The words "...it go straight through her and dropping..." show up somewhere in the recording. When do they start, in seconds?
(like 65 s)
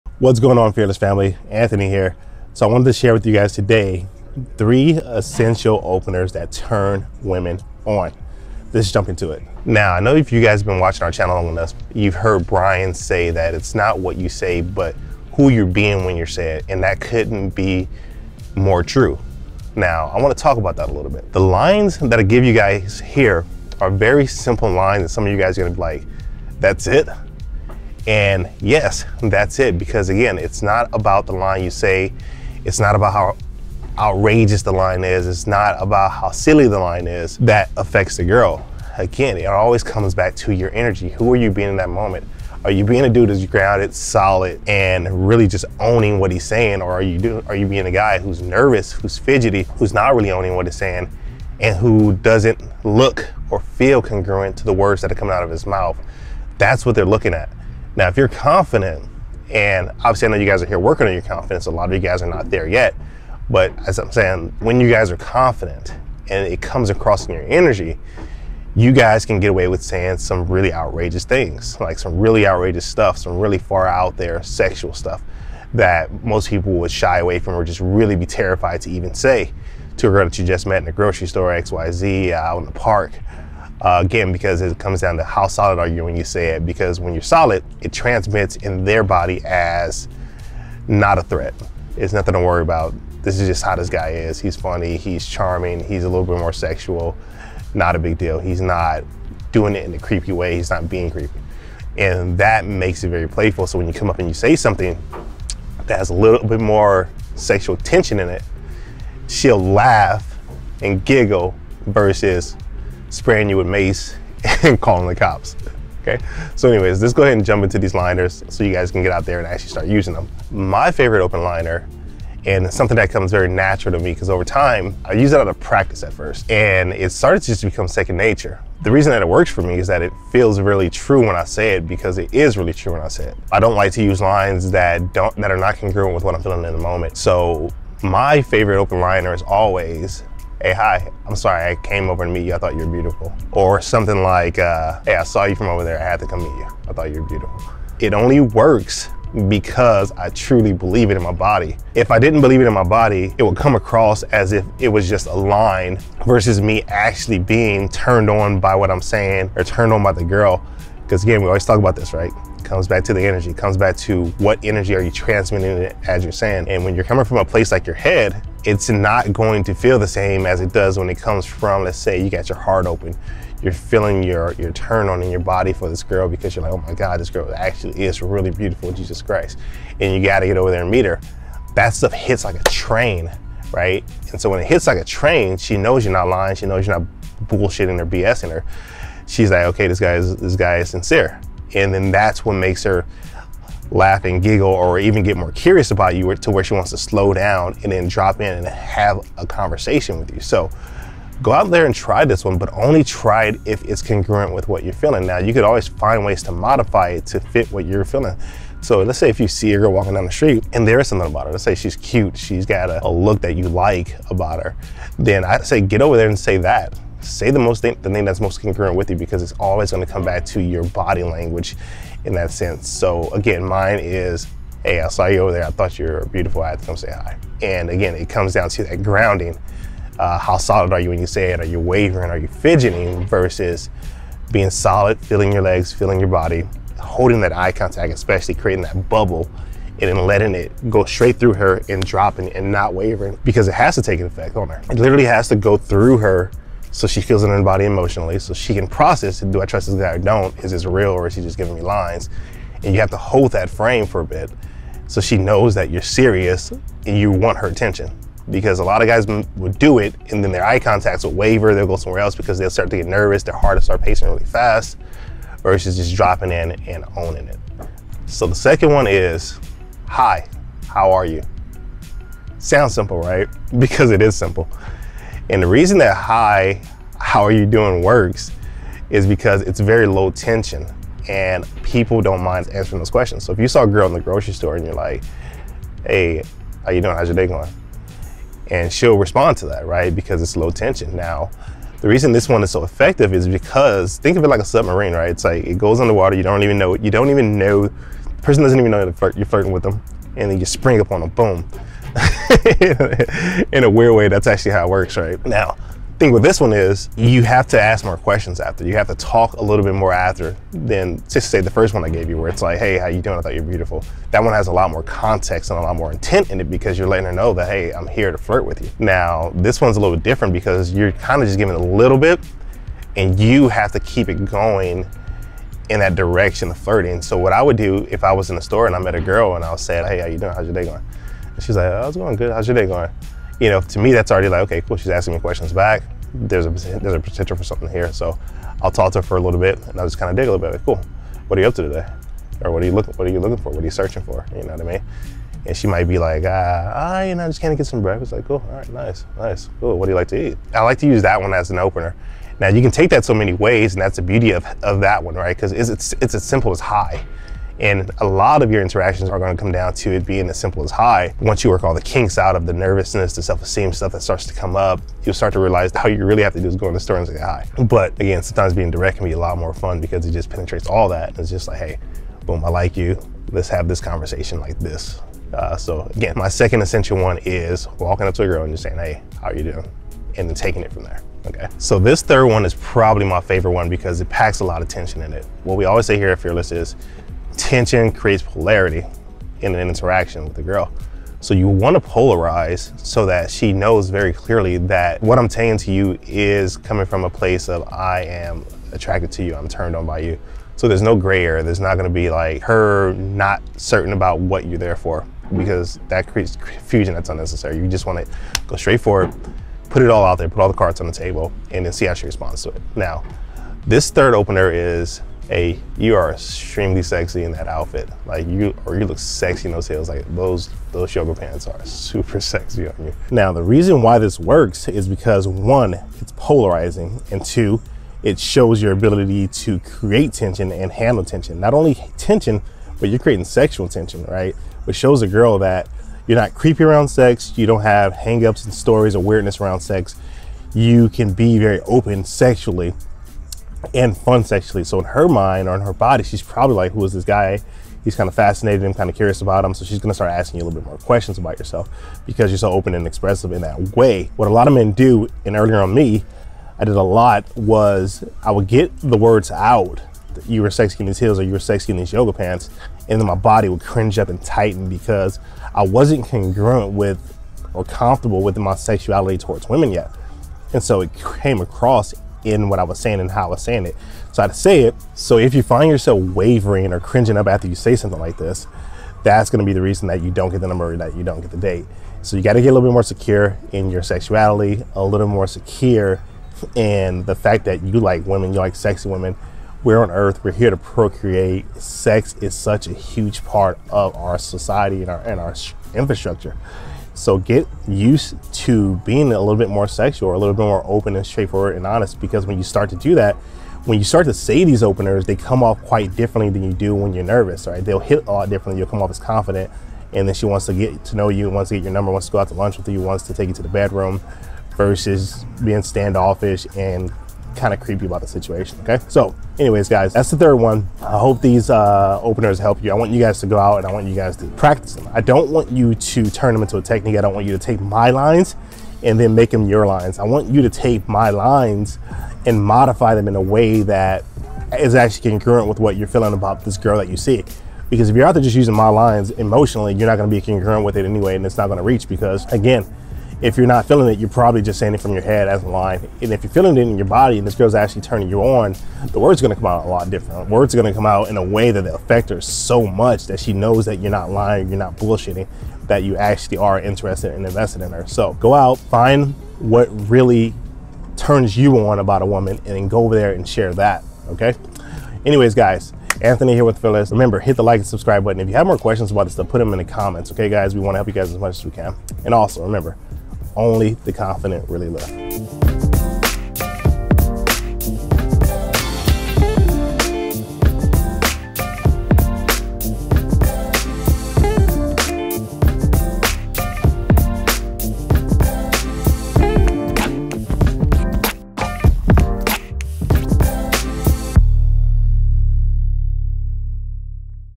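240 s.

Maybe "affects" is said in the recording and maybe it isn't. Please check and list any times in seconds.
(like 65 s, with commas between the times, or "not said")
37 s, 551 s.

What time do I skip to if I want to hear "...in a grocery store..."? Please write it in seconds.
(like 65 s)
80 s.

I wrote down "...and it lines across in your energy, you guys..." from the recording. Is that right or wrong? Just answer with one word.
wrong.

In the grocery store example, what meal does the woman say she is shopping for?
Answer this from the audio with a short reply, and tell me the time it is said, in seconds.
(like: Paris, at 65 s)
Breakfast, at 348 s.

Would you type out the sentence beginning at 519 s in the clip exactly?
So anyways, guys, that's the third one.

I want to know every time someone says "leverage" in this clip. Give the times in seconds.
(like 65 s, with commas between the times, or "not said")
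not said.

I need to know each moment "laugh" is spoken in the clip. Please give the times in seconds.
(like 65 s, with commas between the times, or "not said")
109 s, 193 s.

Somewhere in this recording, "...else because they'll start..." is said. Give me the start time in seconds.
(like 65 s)
262 s.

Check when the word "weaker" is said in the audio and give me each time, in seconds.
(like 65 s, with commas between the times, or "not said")
not said.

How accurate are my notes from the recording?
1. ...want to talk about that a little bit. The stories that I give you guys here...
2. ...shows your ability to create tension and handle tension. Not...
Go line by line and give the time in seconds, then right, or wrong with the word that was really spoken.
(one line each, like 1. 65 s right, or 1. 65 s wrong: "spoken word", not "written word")
1. 20 s wrong: "lines", not "stories"
2. 428 s right.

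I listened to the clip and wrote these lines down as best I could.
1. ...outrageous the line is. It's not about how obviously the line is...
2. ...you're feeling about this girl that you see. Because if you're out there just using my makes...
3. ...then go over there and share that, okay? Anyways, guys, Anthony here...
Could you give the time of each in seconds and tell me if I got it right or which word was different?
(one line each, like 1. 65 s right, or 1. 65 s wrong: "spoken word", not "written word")
1. 33 s wrong: "silly", not "obviously"
2. 535 s wrong: "lines", not "makes"
3. 562 s right.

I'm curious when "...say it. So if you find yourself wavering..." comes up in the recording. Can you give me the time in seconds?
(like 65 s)
474 s.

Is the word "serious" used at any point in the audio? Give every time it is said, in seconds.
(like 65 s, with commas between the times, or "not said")
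256 s.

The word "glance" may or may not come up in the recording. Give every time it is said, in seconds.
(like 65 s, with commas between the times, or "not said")
not said.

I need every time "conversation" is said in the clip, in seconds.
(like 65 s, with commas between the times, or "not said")
199 s, 373 s.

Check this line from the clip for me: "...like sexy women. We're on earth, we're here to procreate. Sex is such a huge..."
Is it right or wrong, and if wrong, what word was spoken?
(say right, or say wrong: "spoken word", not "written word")
right.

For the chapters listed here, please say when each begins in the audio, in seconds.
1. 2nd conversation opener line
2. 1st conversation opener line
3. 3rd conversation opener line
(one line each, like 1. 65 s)
1. 268 s
2. 120 s
3. 382 s.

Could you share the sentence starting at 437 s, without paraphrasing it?
You don't have hangups and stories or weirdness around sex.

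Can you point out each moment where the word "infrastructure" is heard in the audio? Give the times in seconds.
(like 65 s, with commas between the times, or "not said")
495 s.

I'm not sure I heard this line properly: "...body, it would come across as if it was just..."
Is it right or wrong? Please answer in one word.
right.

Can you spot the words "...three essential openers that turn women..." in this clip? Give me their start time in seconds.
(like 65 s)
4 s.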